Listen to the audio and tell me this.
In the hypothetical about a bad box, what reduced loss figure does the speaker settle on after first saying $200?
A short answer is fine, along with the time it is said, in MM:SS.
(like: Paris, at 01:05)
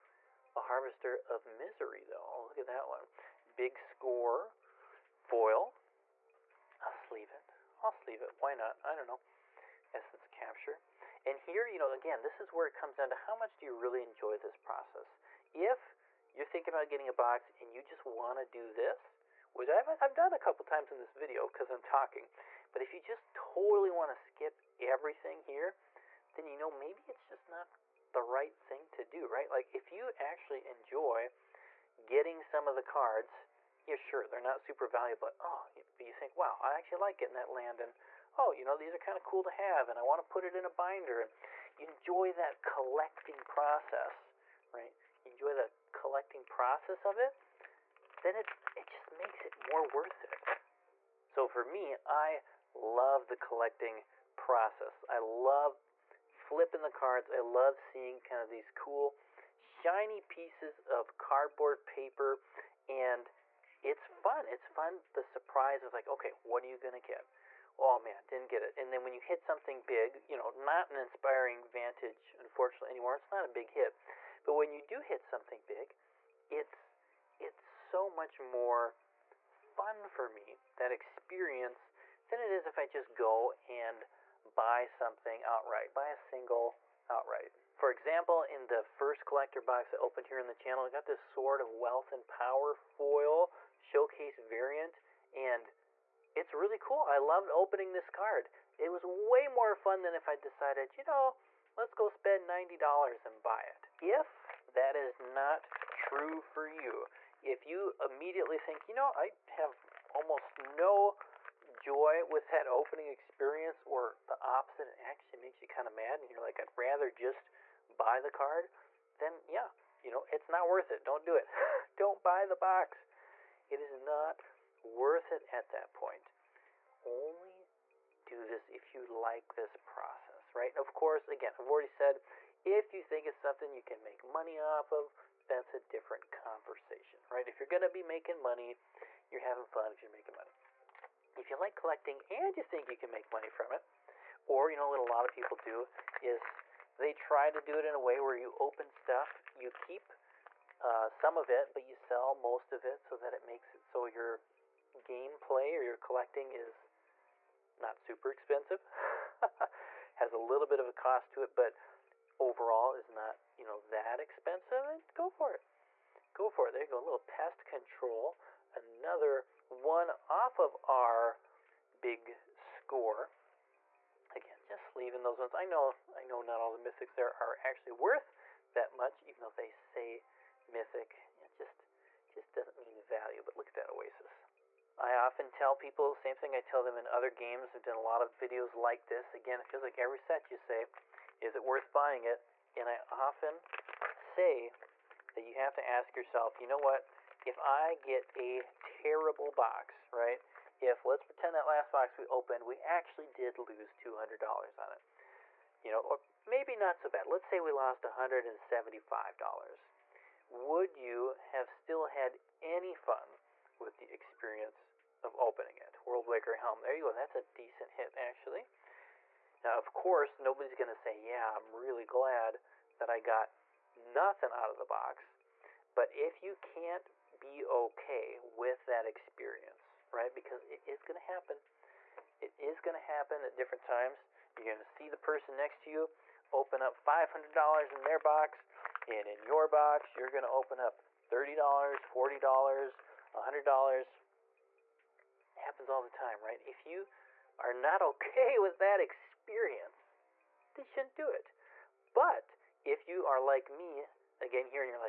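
$175, at 03:28.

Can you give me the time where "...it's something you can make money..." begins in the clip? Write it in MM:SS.
02:13.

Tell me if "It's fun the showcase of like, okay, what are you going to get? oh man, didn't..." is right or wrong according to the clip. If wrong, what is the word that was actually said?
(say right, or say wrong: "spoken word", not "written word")
wrong: "surprise", not "showcase".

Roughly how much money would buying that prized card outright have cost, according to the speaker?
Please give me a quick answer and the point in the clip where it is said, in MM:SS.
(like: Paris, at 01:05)
$90, at 01:42.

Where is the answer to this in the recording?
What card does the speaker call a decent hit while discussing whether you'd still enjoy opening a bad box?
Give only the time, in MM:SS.
03:36.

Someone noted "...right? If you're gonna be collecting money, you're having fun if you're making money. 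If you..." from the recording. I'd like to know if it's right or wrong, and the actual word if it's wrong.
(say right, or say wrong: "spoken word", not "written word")
wrong: "making", not "collecting".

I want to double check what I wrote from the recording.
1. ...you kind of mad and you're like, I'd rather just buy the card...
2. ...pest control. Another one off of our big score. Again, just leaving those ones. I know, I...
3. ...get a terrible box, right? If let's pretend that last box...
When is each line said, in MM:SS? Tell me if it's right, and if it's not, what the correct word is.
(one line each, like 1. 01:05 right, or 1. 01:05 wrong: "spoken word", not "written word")
1. 01:55 right
2. 02:47 right
3. 03:17 right.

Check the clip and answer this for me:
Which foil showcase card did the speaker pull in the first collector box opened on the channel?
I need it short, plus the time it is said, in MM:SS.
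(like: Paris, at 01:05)
Sword of Wealth and Power, at 01:31.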